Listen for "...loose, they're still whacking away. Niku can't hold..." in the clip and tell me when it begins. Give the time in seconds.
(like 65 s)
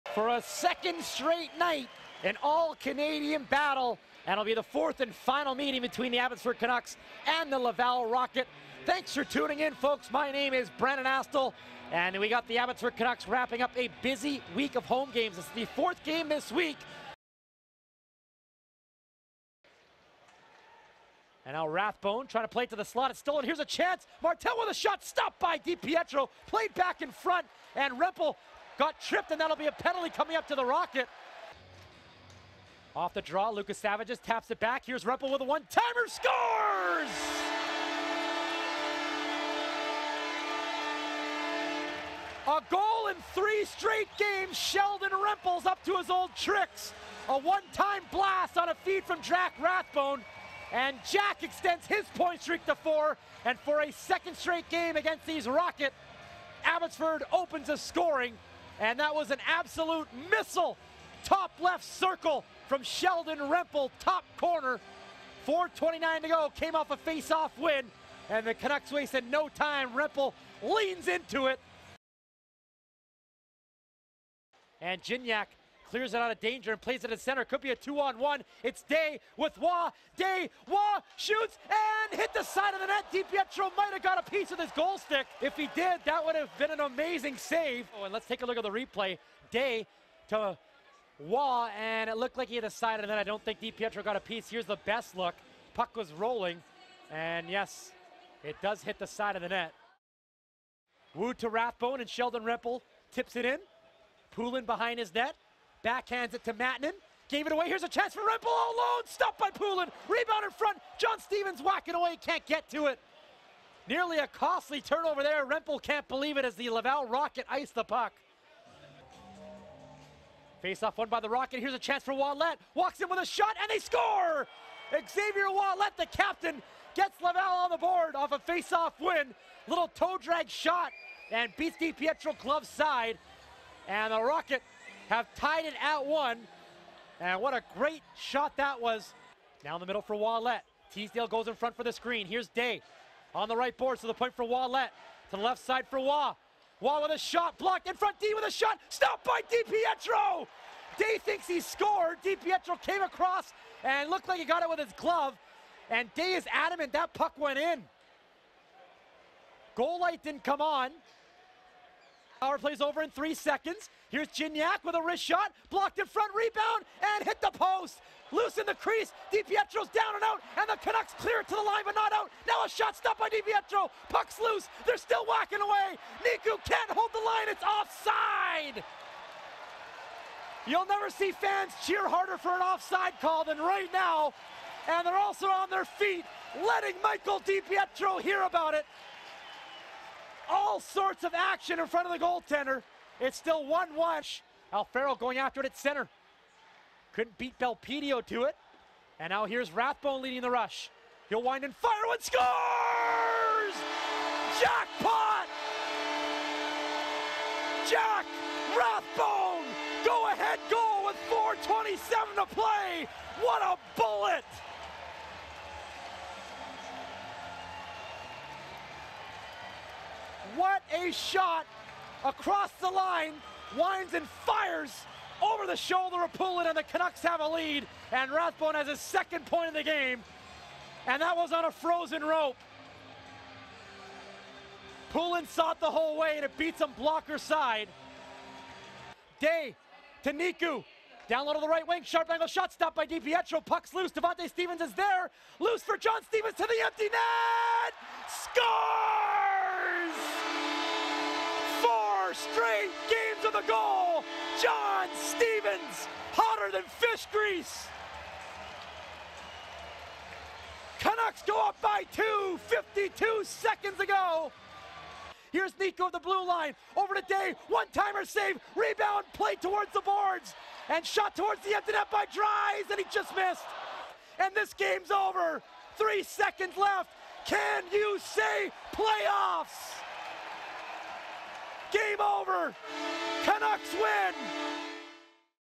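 174 s.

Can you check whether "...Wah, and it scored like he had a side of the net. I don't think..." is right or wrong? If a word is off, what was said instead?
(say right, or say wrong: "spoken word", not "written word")
wrong: "looked", not "scored".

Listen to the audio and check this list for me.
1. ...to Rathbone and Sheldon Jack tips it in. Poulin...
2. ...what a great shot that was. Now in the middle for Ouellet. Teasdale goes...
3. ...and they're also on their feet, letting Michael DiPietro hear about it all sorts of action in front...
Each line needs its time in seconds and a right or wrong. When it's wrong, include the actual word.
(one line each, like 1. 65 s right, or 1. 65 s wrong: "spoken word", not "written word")
1. 101 s wrong: "Rempal", not "Jack"
2. 137 s right
3. 184 s right.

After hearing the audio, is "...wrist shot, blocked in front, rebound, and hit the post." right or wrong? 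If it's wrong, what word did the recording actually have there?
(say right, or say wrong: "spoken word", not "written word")
right.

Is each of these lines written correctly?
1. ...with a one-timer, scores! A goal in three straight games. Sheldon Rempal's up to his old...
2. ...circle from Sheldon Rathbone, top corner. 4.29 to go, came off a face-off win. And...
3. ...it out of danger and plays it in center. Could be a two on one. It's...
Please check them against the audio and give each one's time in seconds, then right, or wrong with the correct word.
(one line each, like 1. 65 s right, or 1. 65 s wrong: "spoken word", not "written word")
1. 35 s right
2. 61 s wrong: "Rempal", not "Rathbone"
3. 76 s right.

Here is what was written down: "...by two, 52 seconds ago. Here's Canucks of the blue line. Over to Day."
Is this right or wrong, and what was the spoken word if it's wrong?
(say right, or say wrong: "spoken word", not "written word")
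wrong: "Niku", not "Canucks".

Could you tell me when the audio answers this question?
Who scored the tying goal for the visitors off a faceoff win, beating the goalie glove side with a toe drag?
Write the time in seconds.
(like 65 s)
124 s.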